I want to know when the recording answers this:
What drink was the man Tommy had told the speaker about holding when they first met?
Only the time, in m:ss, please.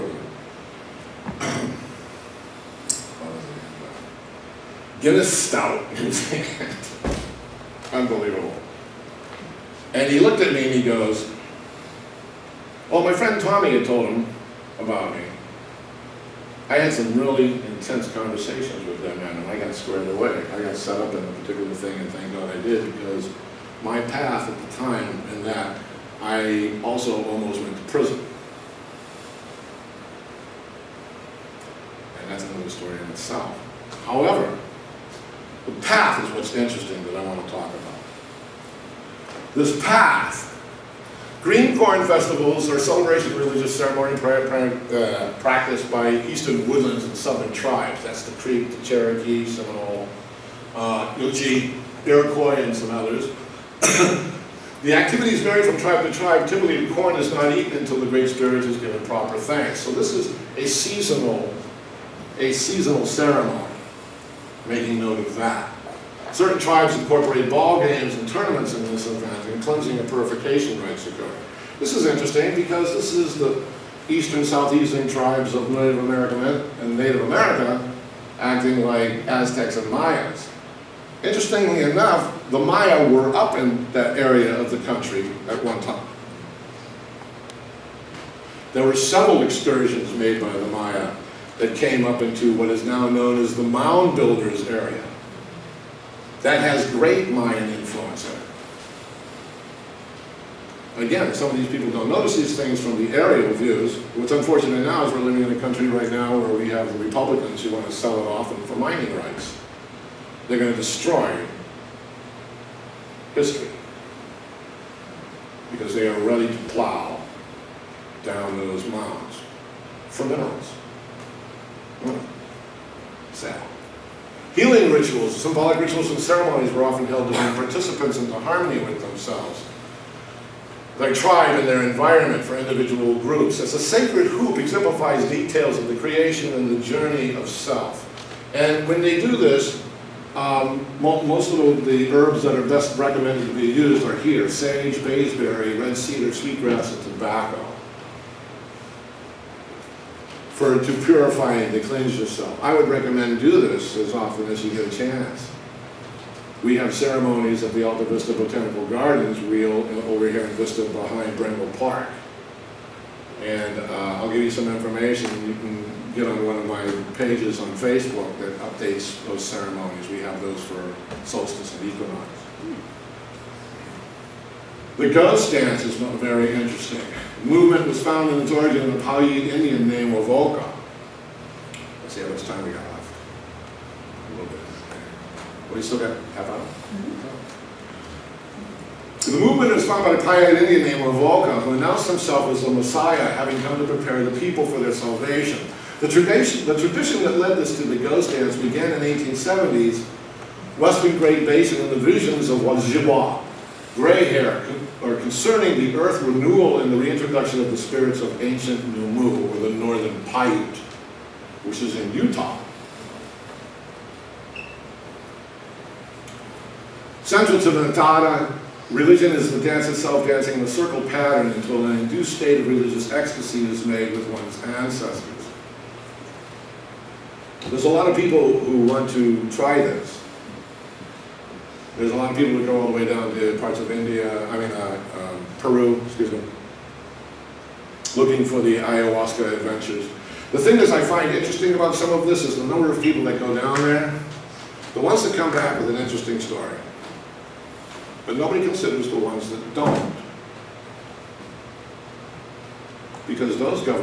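0:05.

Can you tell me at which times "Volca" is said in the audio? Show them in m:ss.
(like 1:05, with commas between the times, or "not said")
3:00, 3:11.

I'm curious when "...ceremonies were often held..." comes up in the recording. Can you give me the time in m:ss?
2:06.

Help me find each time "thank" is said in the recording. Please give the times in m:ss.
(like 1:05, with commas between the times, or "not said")
0:22, 0:59.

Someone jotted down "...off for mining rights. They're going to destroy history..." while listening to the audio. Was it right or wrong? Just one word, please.
right.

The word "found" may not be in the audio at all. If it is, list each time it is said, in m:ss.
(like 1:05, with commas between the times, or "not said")
2:58, 3:09.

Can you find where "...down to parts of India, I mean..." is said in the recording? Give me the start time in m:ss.
3:53.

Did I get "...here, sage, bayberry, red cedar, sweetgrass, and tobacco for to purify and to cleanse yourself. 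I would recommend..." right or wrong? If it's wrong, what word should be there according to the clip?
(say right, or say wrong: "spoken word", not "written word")
right.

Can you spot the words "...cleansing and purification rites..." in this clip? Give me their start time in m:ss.
1:09.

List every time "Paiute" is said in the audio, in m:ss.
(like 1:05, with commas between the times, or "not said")
2:59, 3:10, 3:30.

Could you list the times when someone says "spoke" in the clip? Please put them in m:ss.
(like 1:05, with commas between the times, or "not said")
not said.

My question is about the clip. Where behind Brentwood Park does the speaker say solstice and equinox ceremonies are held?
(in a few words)
Alta Vista Botanical Gardens.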